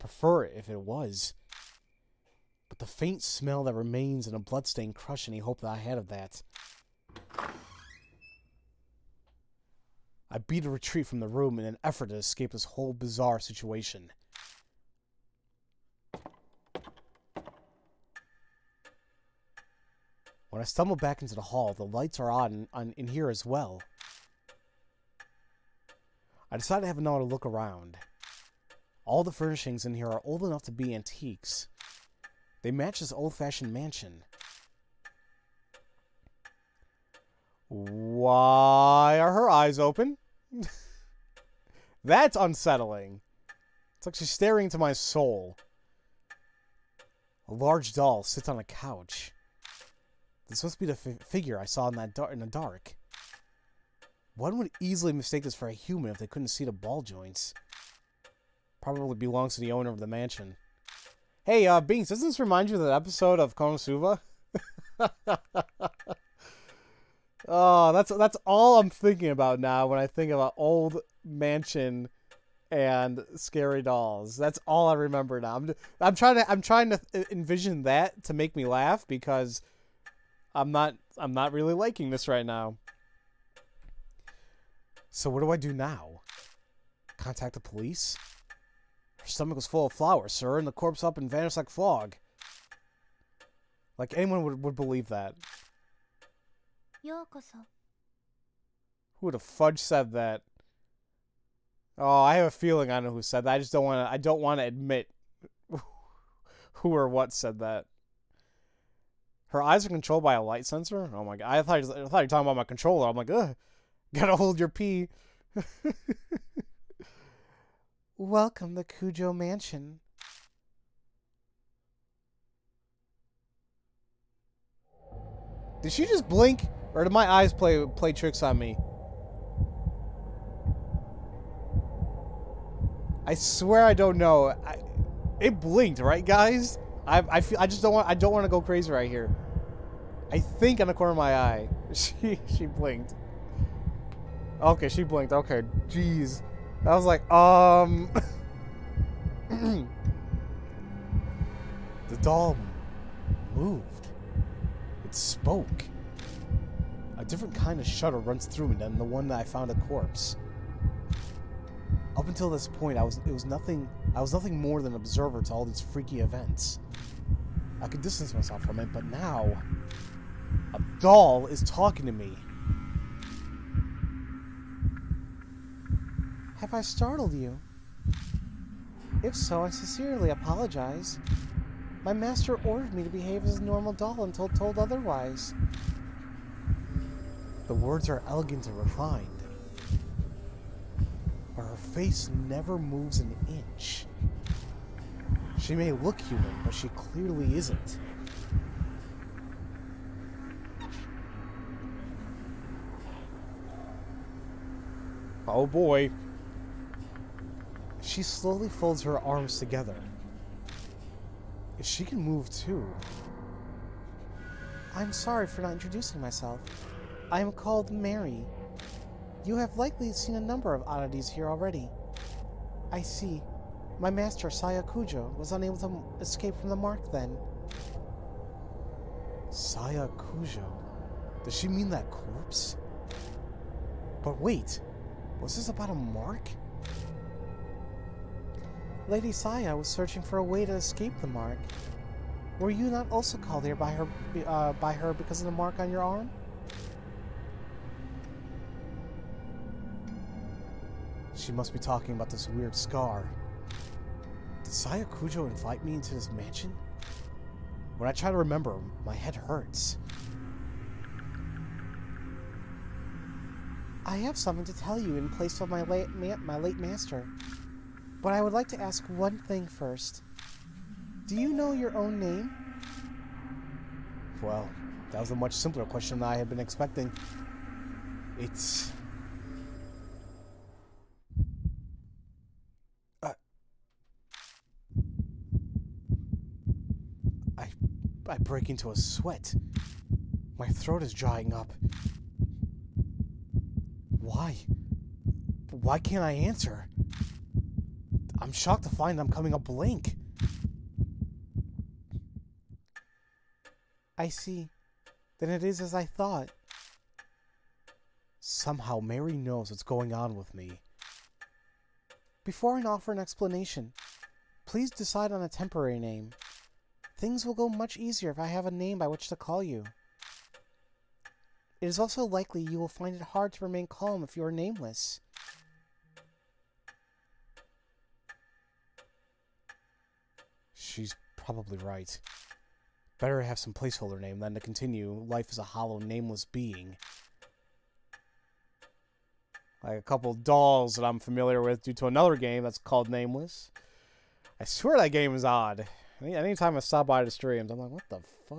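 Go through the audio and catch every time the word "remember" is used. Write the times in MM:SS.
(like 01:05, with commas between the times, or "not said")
01:14, 04:18.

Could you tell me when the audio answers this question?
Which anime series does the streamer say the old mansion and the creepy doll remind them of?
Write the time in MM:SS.
01:03.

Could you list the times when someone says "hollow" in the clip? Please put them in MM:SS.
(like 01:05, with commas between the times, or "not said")
05:35.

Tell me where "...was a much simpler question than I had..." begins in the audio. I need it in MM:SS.
04:35.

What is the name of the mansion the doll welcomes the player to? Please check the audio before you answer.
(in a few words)
Kujo Mansion.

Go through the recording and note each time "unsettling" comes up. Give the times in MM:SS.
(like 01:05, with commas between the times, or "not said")
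00:42.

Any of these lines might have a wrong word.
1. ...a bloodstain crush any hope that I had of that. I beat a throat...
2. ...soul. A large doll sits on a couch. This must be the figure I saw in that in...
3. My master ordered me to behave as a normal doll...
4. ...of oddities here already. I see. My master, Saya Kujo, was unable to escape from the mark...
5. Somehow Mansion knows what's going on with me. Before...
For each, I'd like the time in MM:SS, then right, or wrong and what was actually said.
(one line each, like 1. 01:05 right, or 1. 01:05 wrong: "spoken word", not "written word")
1. 00:04 wrong: "retreat", not "throat"
2. 00:44 right
3. 03:02 right
4. 03:40 right
5. 05:08 wrong: "Mary", not "Mansion".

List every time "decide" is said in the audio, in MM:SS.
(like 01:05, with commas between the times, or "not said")
00:26, 05:14.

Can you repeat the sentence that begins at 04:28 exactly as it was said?
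But I would like to ask one thing first.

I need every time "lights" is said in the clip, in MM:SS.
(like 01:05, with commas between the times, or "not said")
00:21, 01:50.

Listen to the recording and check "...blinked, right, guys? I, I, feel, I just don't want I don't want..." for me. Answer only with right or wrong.
right.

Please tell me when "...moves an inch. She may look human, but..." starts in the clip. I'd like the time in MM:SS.
03:12.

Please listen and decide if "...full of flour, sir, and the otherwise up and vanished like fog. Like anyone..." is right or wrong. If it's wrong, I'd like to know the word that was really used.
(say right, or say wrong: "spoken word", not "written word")
wrong: "corpse", not "otherwise".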